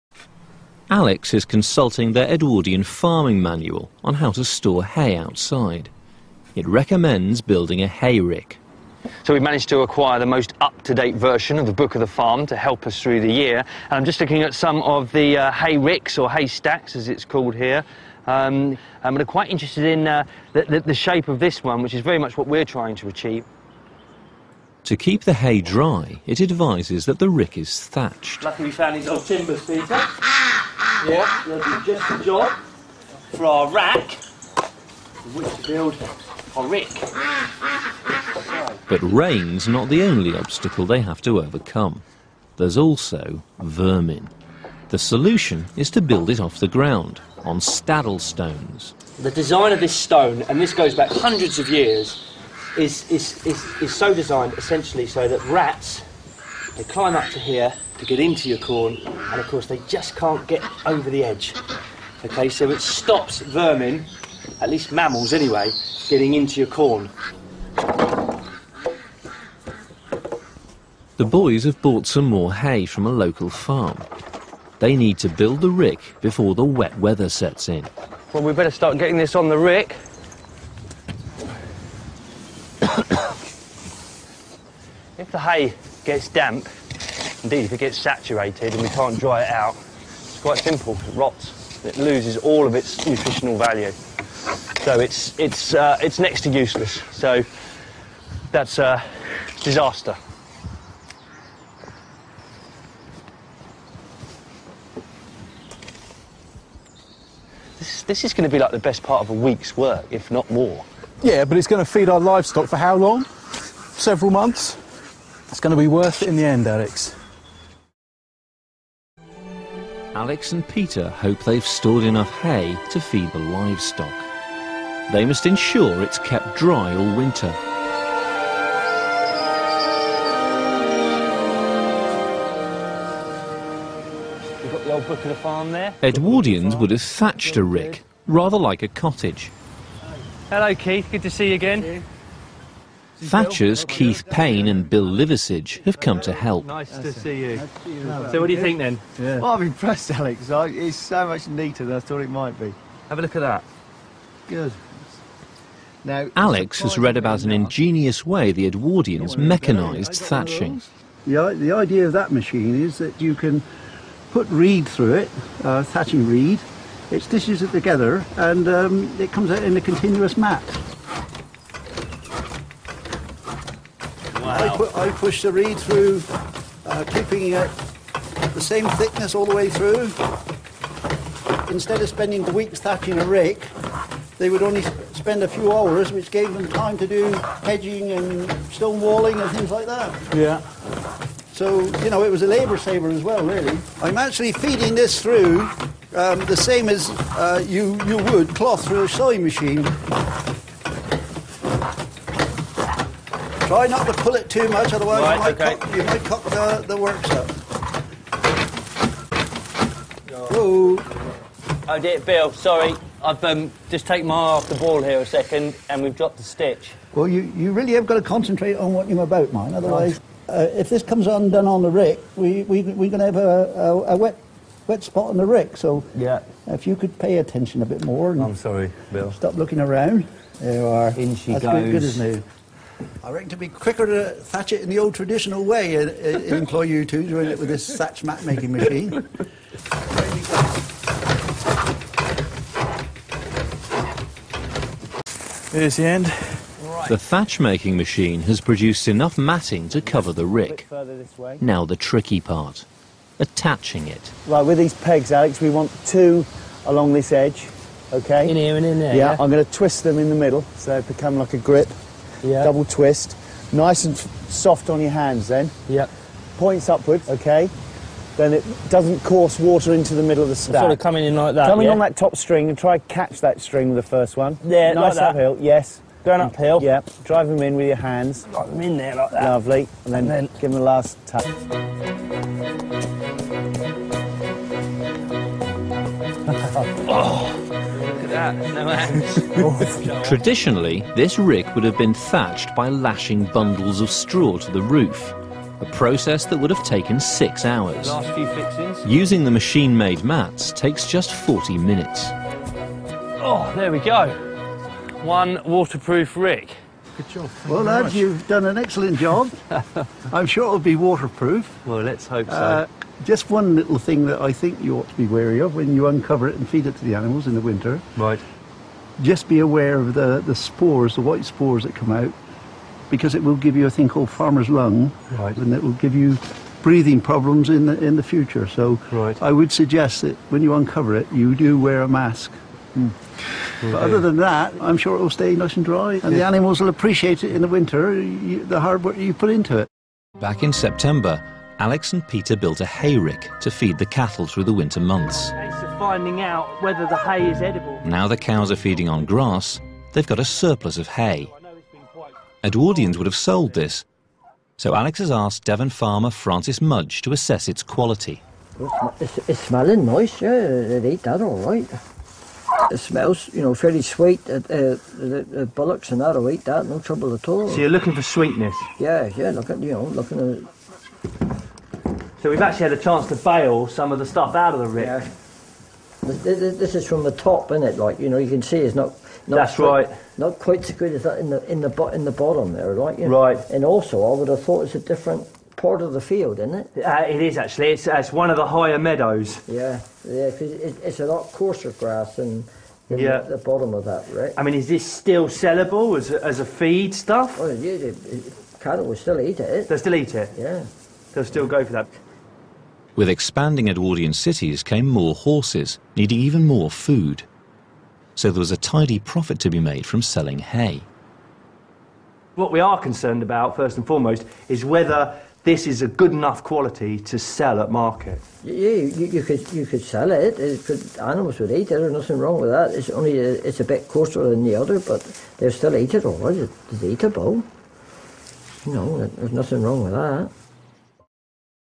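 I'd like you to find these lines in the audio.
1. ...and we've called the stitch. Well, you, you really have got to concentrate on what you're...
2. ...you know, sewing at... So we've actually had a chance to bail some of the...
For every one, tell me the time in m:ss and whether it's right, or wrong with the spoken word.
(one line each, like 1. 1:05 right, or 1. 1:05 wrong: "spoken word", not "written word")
1. 3:35 wrong: "dropped", not "called"
2. 6:09 wrong: "looking", not "sewing".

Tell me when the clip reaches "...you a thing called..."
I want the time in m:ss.
5:23.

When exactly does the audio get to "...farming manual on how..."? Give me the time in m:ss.
0:02.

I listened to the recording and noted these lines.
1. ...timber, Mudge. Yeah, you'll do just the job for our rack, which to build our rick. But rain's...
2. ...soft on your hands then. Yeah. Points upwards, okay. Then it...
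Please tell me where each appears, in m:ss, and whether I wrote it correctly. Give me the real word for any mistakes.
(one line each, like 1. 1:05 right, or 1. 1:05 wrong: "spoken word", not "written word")
1. 0:29 wrong: "Peter", not "Mudge"
2. 4:24 right.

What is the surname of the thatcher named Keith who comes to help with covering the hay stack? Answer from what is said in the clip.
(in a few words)
Payne.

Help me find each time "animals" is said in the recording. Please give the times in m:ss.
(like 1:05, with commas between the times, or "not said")
5:17, 5:36, 7:01.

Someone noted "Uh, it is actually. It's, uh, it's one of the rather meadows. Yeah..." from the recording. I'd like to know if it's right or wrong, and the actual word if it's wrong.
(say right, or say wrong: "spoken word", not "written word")
wrong: "higher", not "rather".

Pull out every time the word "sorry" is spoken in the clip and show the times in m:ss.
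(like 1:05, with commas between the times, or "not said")
3:32, 3:48.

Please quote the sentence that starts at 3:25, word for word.
cock, you might cock the, the works up.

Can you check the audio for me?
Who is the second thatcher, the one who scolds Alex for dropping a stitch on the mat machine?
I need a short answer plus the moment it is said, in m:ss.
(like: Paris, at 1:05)
Bill Liversidge, at 2:24.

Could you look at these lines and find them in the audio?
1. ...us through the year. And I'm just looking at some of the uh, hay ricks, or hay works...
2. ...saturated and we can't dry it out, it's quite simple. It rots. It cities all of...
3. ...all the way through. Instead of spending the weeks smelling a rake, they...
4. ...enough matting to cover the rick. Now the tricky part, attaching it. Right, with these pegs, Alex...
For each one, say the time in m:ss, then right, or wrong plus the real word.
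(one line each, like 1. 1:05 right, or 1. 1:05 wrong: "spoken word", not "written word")
1. 0:12 wrong: "stacks", not "works"
2. 1:27 wrong: "loses", not "cities"
3. 2:59 wrong: "thatching", not "smelling"
4. 4:09 right.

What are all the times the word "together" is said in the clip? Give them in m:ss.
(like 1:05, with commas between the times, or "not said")
2:47.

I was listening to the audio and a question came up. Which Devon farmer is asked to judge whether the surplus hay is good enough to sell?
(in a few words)
Francis Mudge.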